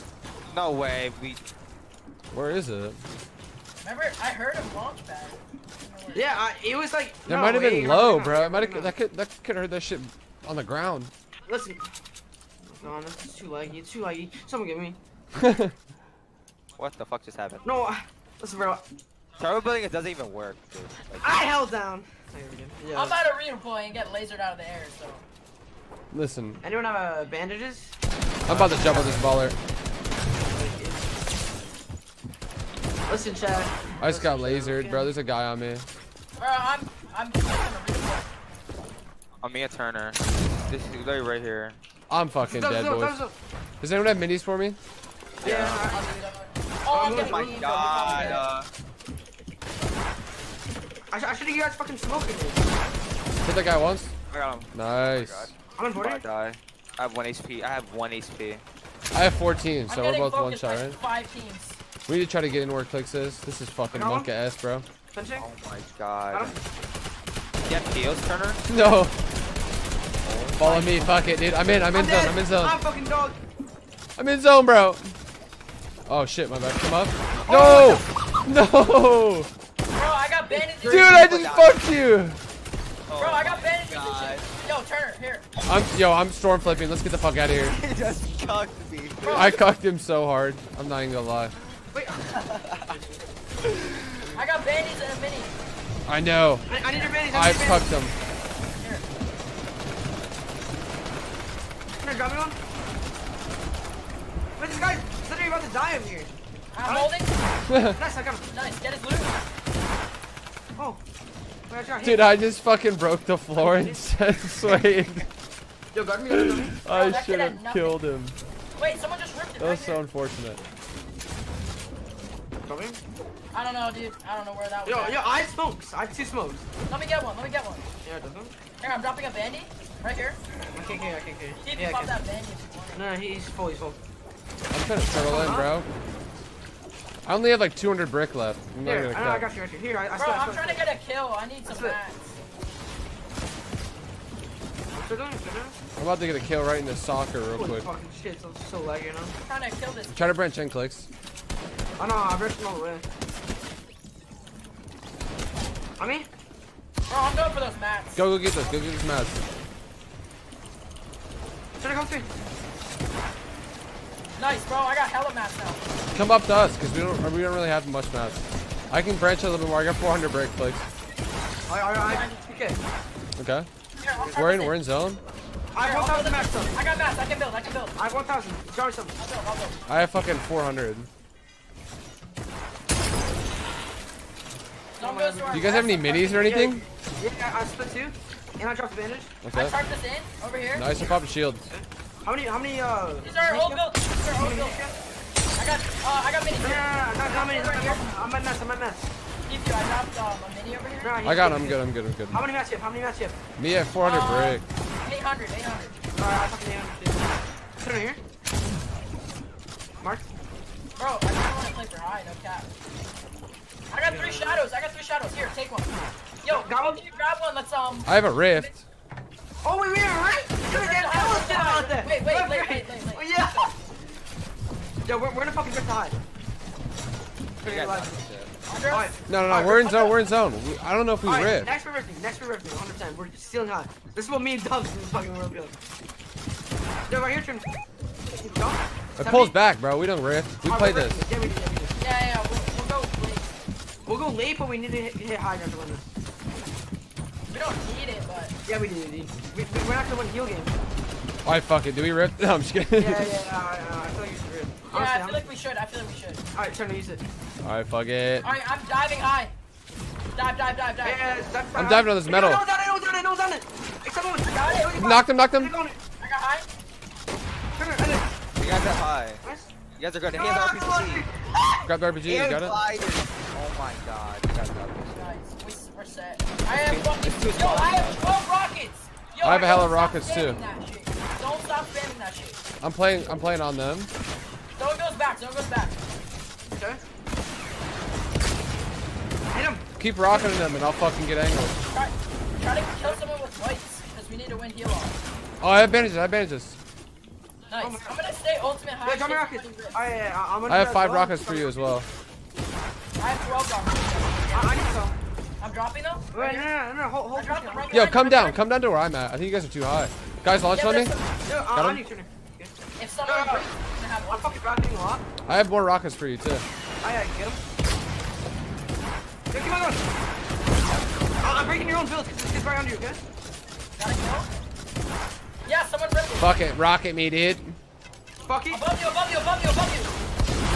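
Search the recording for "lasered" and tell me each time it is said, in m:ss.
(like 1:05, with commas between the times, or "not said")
0:24, 0:34.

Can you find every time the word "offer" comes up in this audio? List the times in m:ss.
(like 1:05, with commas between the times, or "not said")
not said.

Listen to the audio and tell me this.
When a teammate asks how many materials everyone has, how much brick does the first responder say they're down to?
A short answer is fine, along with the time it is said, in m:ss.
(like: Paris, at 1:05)
400, at 3:23.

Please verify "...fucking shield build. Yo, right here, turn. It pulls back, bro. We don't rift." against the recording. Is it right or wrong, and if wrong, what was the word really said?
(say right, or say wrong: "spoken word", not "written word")
wrong: "world", not "shield".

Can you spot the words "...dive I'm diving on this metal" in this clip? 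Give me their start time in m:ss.
4:21.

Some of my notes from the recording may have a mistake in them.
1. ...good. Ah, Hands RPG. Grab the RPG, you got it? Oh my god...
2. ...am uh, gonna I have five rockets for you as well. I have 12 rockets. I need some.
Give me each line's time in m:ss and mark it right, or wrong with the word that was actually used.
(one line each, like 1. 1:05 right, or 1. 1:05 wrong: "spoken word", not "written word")
1. 4:30 right
2. 5:00 right.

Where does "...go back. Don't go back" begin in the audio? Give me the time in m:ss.
4:44.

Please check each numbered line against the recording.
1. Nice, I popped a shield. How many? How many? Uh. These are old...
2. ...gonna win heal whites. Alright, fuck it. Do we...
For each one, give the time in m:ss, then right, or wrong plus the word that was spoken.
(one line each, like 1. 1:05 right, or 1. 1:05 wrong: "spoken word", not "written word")
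1. 3:10 right
2. 4:10 wrong: "games", not "whites".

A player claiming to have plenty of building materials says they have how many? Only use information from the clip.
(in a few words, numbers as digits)
1,000.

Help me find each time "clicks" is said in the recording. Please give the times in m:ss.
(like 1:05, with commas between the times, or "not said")
1:02, 2:30.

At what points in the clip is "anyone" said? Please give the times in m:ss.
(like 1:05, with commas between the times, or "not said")
0:26, 0:43.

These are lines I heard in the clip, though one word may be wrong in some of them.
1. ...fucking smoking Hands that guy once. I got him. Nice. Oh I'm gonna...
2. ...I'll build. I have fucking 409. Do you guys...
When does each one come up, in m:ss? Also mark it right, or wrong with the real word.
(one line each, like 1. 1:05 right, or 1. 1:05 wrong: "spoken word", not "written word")
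1. 0:51 wrong: "Hit", not "Hands"
2. 2:59 wrong: "400", not "409".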